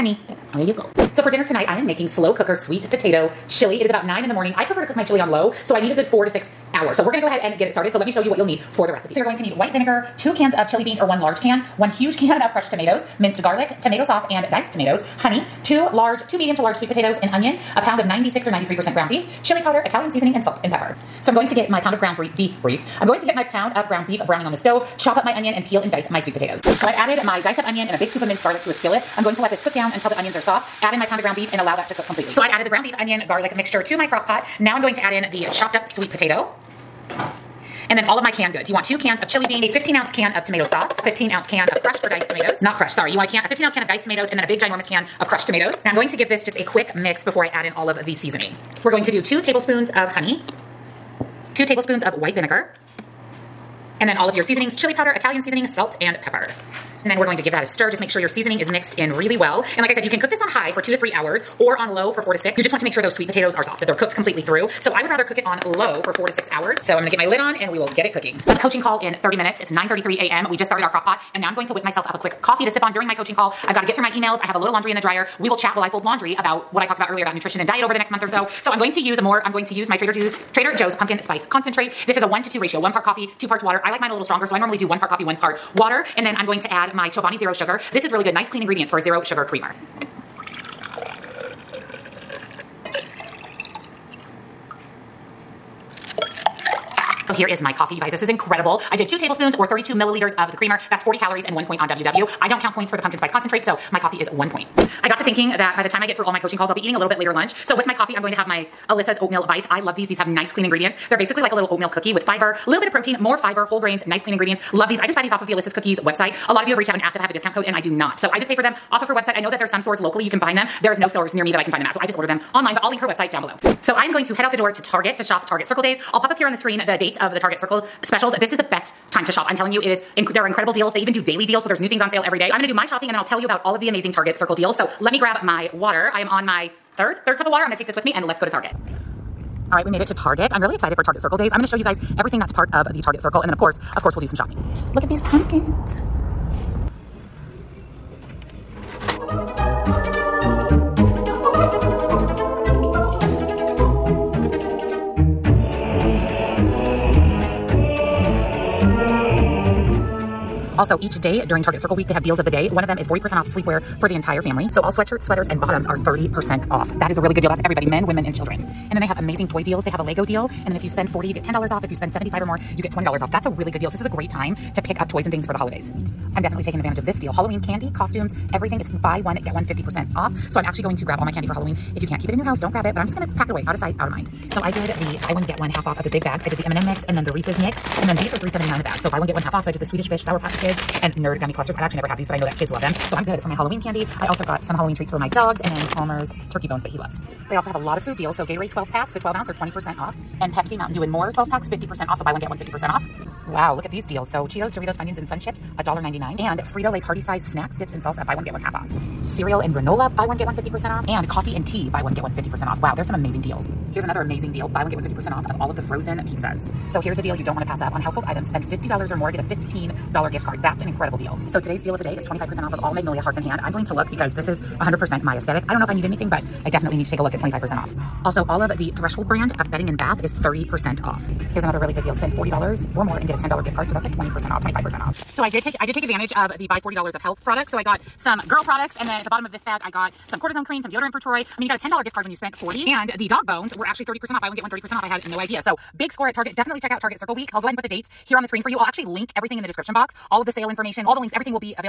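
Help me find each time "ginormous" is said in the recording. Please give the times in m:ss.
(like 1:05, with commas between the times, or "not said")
0:44.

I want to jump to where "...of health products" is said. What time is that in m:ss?
3:57.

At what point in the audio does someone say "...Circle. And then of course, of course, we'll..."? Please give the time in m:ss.
2:23.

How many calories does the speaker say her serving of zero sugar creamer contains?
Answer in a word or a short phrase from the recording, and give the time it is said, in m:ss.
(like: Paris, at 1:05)
40, at 1:41.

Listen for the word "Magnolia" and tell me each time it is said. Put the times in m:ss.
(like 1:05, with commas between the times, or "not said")
3:42.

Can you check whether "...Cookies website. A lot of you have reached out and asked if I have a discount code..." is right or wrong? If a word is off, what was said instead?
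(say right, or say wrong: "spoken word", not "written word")
right.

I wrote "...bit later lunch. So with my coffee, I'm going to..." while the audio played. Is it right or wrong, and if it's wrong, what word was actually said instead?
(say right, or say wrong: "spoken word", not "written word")
right.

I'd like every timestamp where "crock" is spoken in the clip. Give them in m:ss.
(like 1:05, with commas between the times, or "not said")
0:34, 1:10.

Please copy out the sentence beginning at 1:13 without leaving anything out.
I've got to get through my emails.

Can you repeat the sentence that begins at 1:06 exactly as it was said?
So I'm gonna get my lid on and we will get it cooking.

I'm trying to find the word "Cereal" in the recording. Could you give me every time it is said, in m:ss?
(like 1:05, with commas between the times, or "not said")
3:29.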